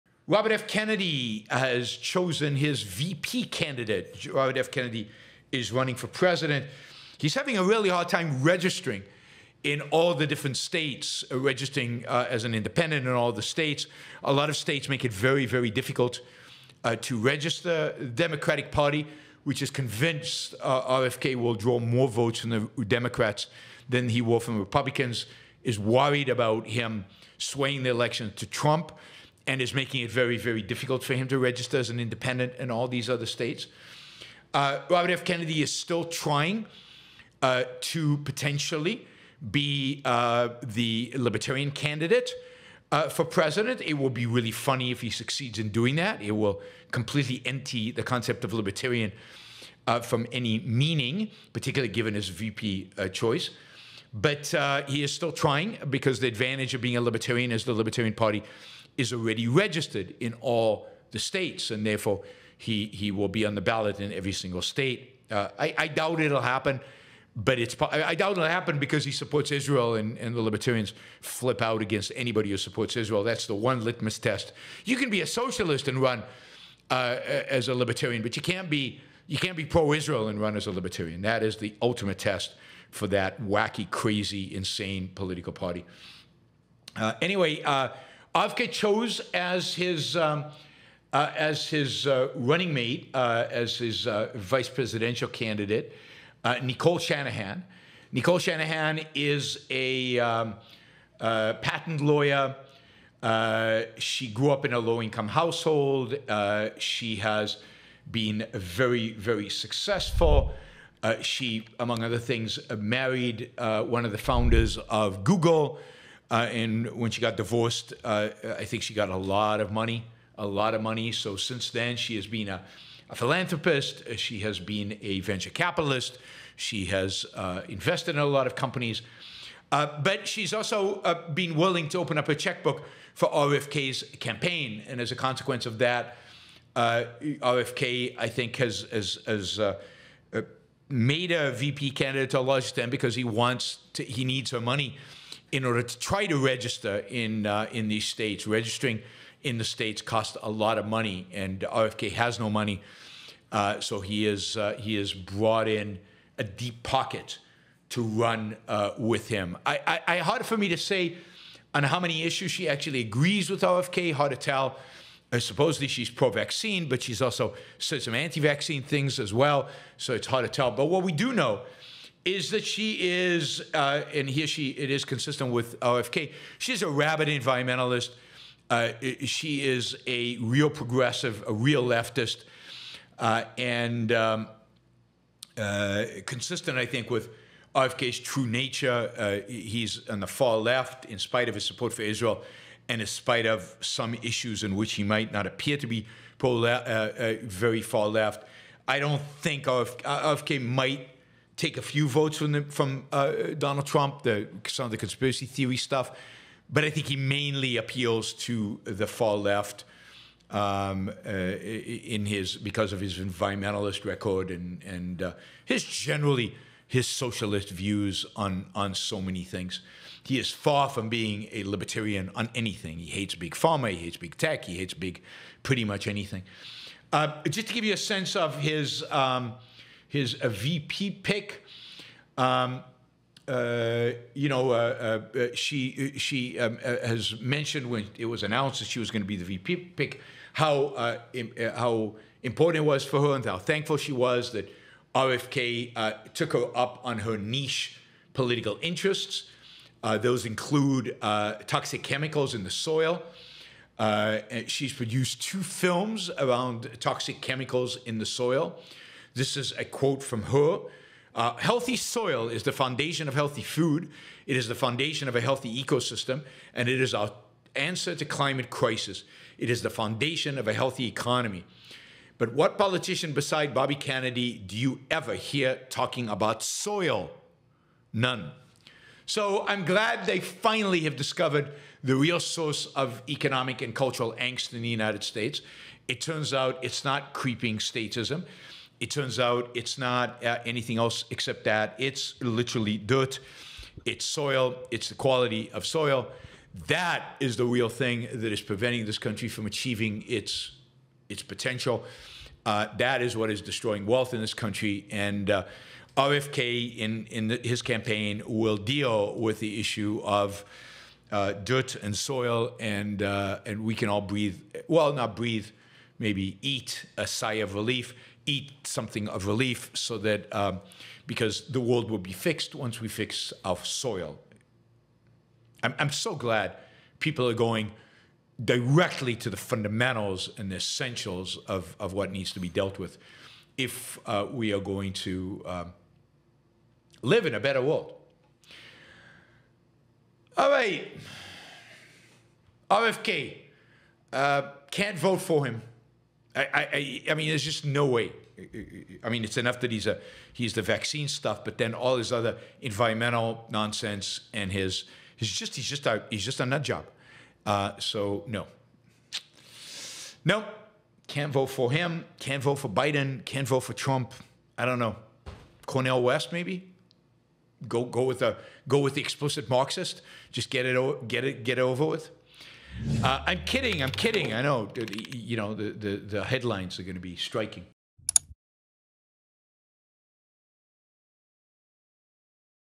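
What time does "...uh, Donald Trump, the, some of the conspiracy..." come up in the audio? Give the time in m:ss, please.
3:23.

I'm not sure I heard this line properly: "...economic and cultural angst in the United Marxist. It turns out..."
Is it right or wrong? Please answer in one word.
wrong.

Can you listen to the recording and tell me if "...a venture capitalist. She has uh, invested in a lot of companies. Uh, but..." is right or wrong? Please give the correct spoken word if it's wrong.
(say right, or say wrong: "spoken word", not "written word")
right.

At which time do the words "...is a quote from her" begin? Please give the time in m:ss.
4:19.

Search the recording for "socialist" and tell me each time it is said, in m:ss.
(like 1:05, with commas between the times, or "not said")
1:15, 3:37.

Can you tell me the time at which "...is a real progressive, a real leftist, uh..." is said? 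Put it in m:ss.
2:59.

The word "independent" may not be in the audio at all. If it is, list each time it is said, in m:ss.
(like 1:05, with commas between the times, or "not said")
0:12, 0:31.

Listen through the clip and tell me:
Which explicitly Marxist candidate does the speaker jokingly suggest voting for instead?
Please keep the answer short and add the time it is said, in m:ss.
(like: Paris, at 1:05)
Cornel West, at 6:05.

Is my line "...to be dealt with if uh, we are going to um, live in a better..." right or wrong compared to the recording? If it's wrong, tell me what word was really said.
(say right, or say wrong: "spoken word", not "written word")
right.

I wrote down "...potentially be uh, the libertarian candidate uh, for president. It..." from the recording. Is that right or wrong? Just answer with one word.
right.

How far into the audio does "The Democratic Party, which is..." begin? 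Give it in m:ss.
0:17.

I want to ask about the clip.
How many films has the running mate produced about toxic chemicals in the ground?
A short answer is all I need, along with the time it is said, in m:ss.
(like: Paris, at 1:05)
2, at 4:15.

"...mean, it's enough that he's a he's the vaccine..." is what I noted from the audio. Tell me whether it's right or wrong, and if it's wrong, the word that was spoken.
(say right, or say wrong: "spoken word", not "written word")
right.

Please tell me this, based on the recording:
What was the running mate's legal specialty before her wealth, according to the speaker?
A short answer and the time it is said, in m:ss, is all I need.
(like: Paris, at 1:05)
patent lawyer, at 1:41.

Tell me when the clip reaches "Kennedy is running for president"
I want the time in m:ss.
0:04.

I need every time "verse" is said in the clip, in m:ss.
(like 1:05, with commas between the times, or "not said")
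not said.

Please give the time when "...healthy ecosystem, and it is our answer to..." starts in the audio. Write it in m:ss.
4:25.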